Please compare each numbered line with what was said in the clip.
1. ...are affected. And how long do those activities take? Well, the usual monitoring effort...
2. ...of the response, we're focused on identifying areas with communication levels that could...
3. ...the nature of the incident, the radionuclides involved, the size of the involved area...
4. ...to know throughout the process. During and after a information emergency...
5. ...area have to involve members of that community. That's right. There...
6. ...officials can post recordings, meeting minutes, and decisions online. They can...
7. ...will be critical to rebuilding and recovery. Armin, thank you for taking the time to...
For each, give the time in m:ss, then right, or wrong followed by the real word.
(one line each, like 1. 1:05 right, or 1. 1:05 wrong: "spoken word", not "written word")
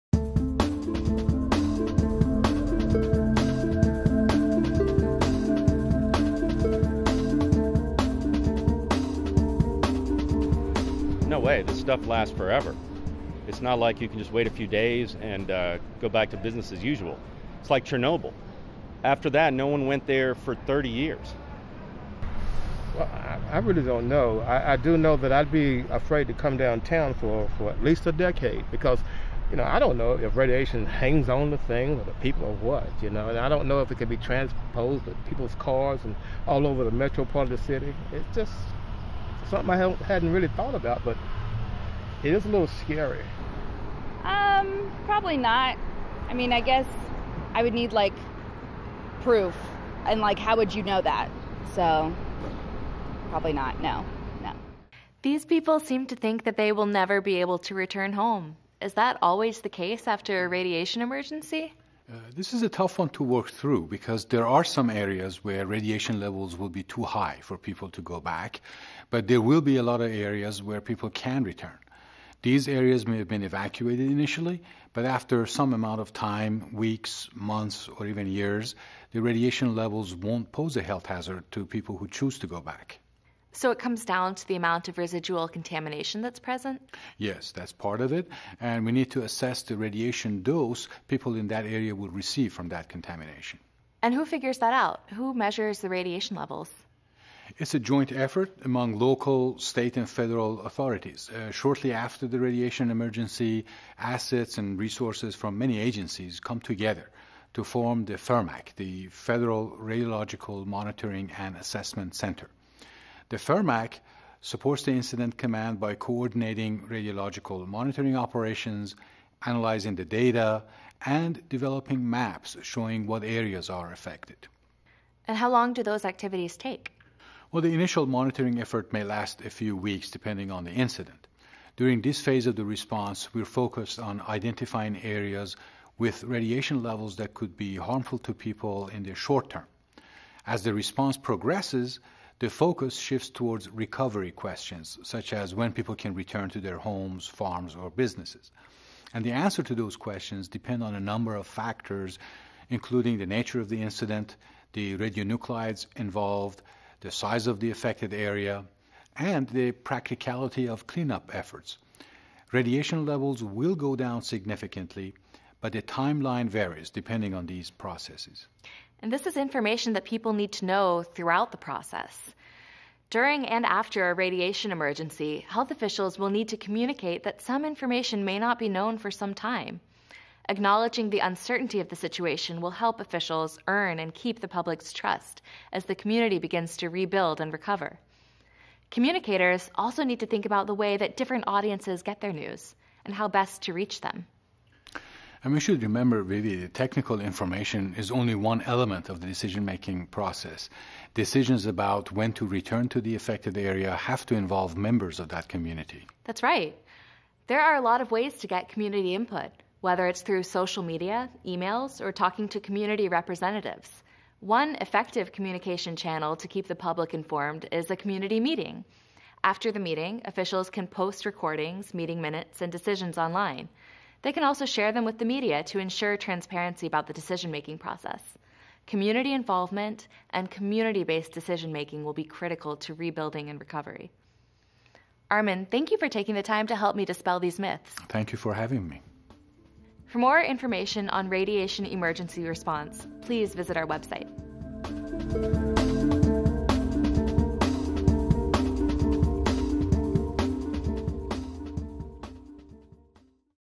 1. 2:03 wrong: "initial", not "usual"
2. 2:12 wrong: "radiation", not "communication"
3. 2:33 wrong: "affected", not "involved"
4. 2:50 wrong: "radiation", not "information"
5. 3:23 right
6. 3:40 right
7. 3:52 right.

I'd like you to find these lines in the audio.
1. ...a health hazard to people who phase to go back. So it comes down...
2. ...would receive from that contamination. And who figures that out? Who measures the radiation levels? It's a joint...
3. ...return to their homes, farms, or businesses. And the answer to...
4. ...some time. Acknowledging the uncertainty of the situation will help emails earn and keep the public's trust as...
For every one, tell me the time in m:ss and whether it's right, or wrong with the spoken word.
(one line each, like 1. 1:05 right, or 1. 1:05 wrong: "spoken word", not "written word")
1. 1:20 wrong: "choose", not "phase"
2. 1:31 right
3. 2:26 right
4. 2:59 wrong: "officials", not "emails".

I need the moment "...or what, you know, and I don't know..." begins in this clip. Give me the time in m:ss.
0:32.